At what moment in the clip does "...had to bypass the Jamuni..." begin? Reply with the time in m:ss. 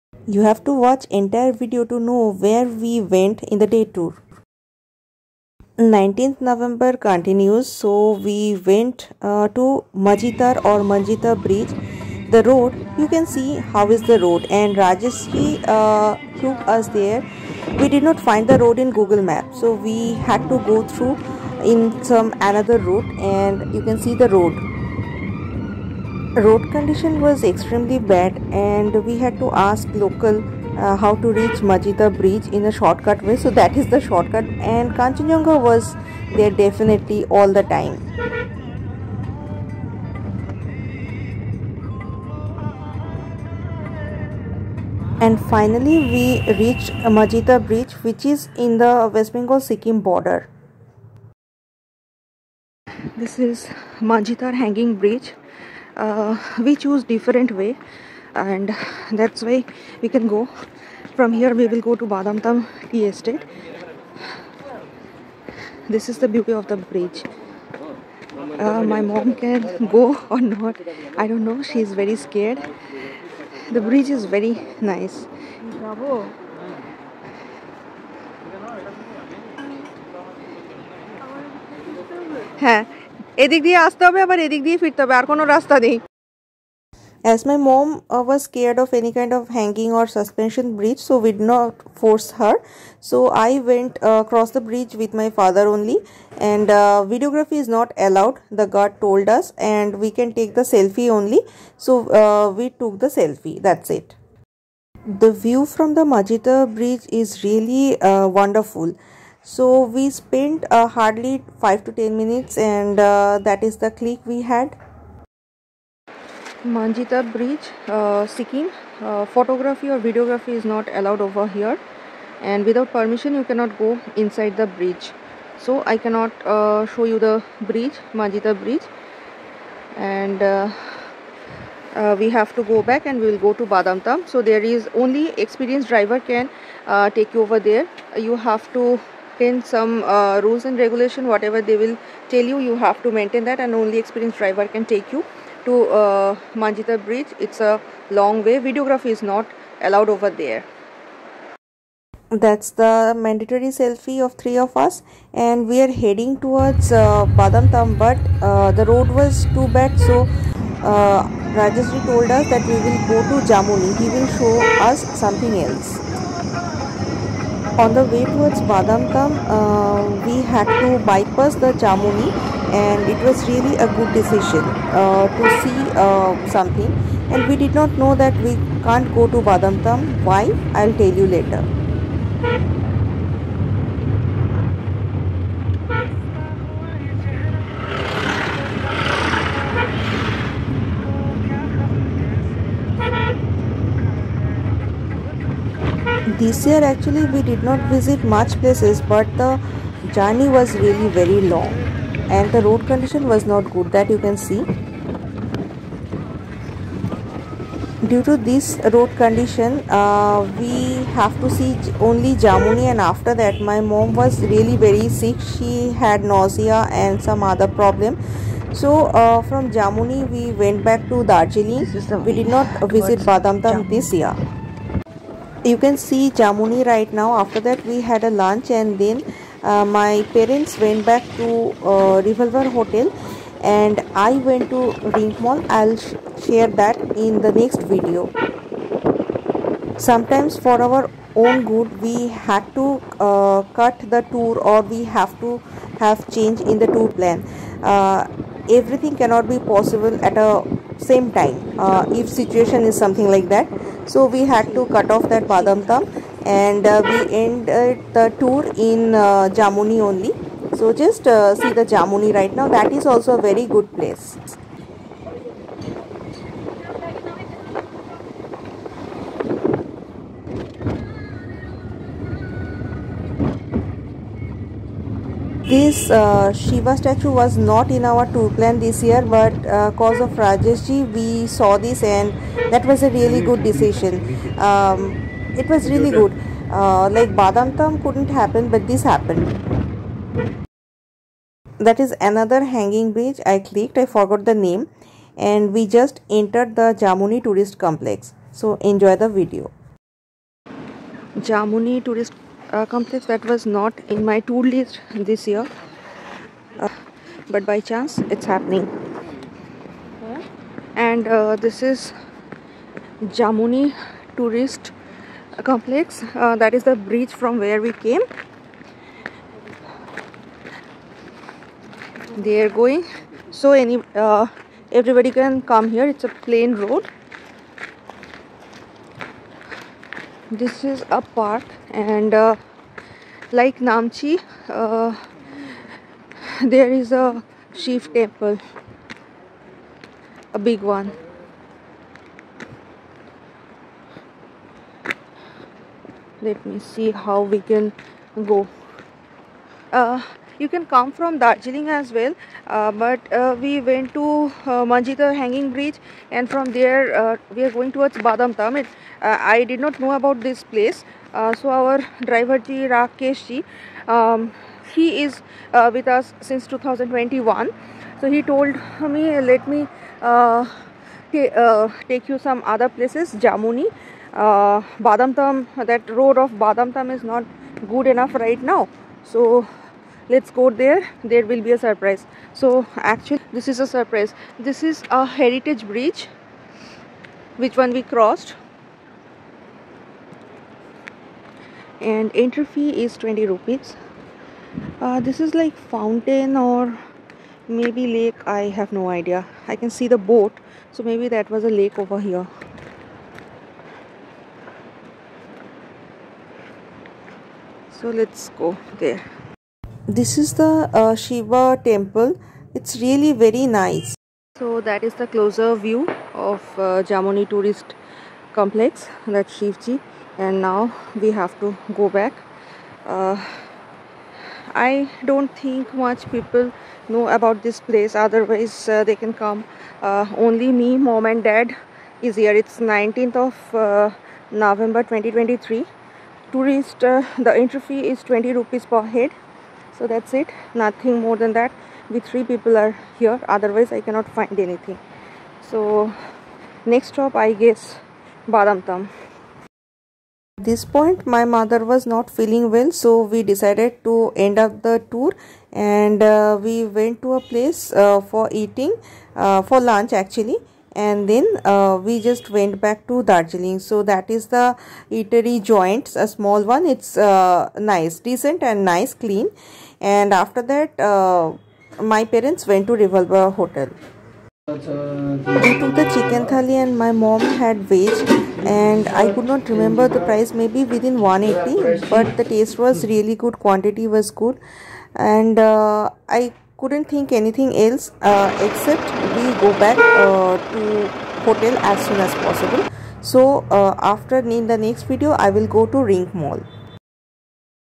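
2:50.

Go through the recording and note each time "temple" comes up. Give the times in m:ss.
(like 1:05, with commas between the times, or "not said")
5:38, 6:51.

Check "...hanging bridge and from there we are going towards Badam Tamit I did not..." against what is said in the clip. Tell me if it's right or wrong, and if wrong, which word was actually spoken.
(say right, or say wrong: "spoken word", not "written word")
right.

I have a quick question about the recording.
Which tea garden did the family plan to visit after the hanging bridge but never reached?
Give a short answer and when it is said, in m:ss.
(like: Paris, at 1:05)
Badamtam tea estate, at 1:02.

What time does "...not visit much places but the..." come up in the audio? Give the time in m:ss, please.
3:17.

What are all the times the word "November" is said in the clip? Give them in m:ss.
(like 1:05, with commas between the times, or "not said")
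0:06, 7:14.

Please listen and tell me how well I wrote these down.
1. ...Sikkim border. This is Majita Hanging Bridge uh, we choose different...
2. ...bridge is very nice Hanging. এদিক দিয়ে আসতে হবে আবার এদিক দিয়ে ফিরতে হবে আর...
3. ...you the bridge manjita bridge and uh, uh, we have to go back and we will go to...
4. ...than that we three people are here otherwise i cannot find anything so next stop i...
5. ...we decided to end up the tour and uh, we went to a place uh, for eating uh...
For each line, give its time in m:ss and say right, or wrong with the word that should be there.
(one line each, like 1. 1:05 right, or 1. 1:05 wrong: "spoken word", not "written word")
1. 0:49 right
2. 1:13 wrong: "Bravo", not "Hanging"
3. 2:07 right
4. 7:21 right
5. 7:33 right.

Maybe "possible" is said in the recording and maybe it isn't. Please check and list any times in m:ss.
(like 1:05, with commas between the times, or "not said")
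4:09, 8:12.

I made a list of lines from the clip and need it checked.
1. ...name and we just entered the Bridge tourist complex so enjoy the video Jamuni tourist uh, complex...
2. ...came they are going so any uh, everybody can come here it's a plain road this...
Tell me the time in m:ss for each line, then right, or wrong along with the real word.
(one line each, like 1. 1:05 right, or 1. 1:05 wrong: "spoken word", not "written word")
1. 4:54 wrong: "Jamuni", not "Bridge"
2. 5:17 right.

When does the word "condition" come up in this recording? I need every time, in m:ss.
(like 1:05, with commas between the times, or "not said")
0:26, 3:22, 3:29.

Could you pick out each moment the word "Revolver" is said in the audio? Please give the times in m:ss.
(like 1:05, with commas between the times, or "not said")
3:52, 7:52.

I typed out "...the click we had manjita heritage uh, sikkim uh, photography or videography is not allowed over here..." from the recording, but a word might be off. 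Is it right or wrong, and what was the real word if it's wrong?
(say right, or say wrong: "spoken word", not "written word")
wrong: "bridge", not "heritage".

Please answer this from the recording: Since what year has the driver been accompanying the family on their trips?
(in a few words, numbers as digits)
2021.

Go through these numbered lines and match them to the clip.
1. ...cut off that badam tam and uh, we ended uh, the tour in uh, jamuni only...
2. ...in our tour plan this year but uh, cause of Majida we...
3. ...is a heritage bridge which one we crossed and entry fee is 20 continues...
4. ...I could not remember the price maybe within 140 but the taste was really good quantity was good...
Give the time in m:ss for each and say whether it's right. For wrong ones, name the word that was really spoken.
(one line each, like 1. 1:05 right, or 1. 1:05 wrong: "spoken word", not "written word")
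1. 4:14 right
2. 4:37 wrong: "Rajeshji", not "Majida"
3. 6:24 wrong: "rupees", not "continues"
4. 7:59 wrong: "180", not "140".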